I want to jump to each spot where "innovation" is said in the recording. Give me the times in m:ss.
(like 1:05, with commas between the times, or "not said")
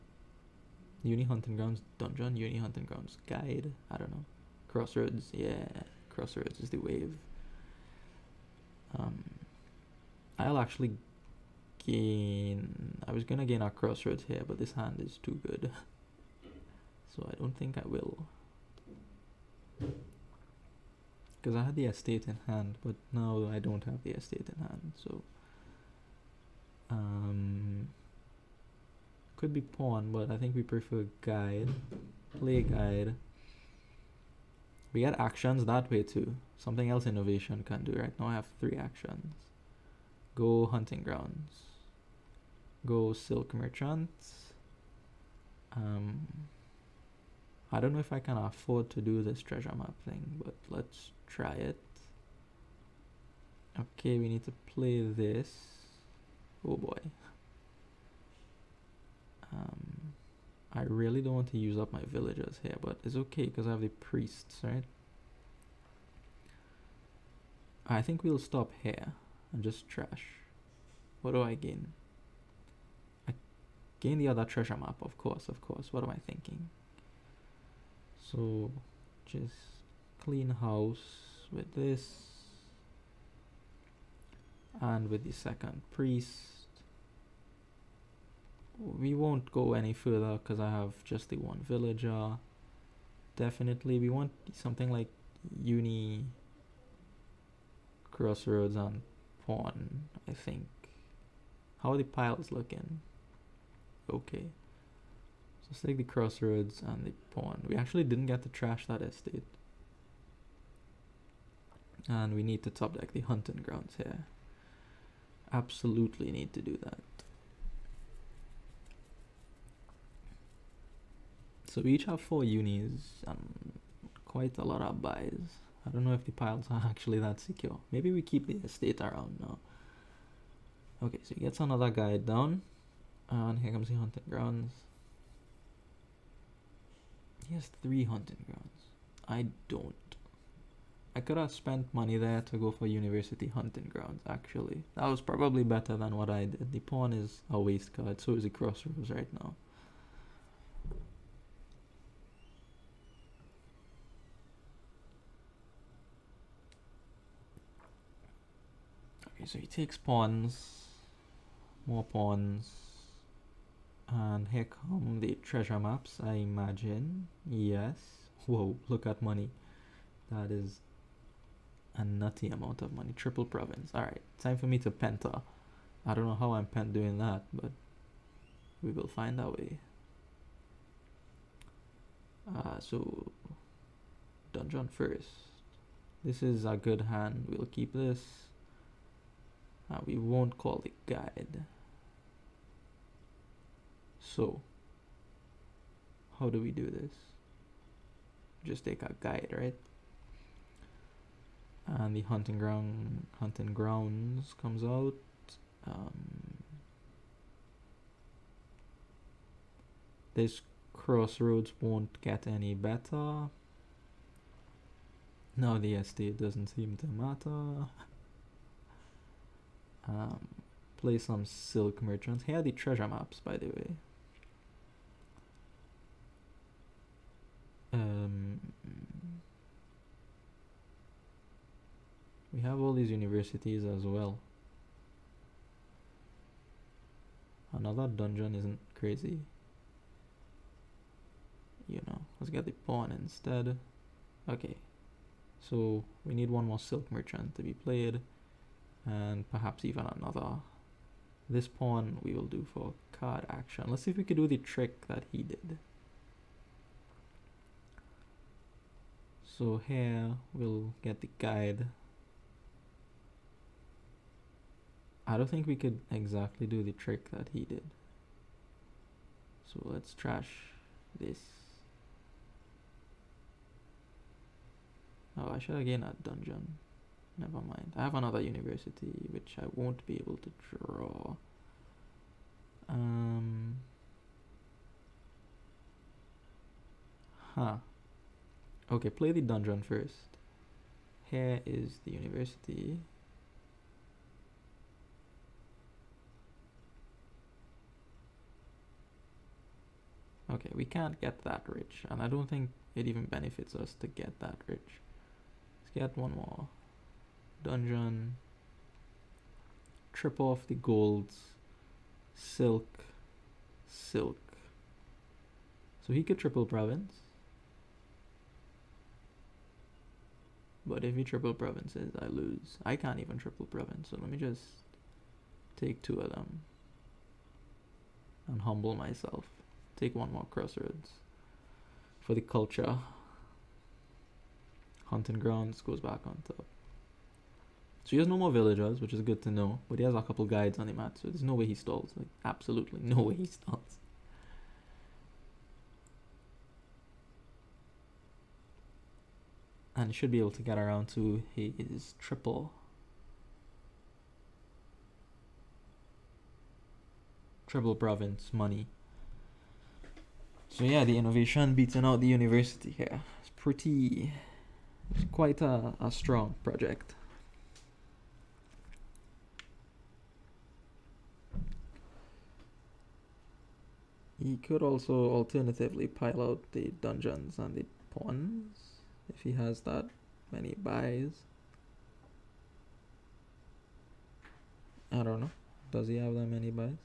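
0:37, 6:01.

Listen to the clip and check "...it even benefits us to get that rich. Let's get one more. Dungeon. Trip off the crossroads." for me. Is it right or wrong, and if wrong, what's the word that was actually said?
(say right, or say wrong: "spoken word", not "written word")
wrong: "golds", not "crossroads".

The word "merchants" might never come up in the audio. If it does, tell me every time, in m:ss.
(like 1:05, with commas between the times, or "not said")
0:43, 3:42, 4:07.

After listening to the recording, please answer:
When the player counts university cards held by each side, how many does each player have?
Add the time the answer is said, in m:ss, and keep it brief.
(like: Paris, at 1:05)
four, at 2:01.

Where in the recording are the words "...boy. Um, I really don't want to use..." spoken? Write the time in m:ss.
0:56.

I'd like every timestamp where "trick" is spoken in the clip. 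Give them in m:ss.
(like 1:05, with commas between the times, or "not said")
4:14, 4:26.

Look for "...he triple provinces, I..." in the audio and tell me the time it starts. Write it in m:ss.
5:21.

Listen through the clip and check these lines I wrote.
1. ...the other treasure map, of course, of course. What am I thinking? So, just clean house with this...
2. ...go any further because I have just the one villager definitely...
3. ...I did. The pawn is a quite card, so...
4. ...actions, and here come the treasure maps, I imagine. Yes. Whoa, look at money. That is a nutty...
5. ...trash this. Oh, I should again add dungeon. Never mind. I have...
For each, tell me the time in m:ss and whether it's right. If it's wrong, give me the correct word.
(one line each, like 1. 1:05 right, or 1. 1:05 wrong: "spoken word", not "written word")
1. 1:14 right
2. 1:29 right
3. 2:26 wrong: "waste", not "quite"
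4. 2:42 wrong: "pawns", not "actions"
5. 4:30 right.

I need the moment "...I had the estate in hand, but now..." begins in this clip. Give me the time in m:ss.
0:21.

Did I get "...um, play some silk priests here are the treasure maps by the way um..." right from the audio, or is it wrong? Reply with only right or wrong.
wrong.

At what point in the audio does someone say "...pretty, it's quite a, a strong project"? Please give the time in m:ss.
6:03.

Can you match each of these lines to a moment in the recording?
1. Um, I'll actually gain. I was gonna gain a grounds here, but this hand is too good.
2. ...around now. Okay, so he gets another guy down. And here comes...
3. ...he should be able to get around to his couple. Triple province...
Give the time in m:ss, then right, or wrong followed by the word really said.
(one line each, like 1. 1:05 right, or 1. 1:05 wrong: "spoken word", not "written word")
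1. 0:08 wrong: "crossroads", not "grounds"
2. 2:08 right
3. 5:50 wrong: "triple", not "couple".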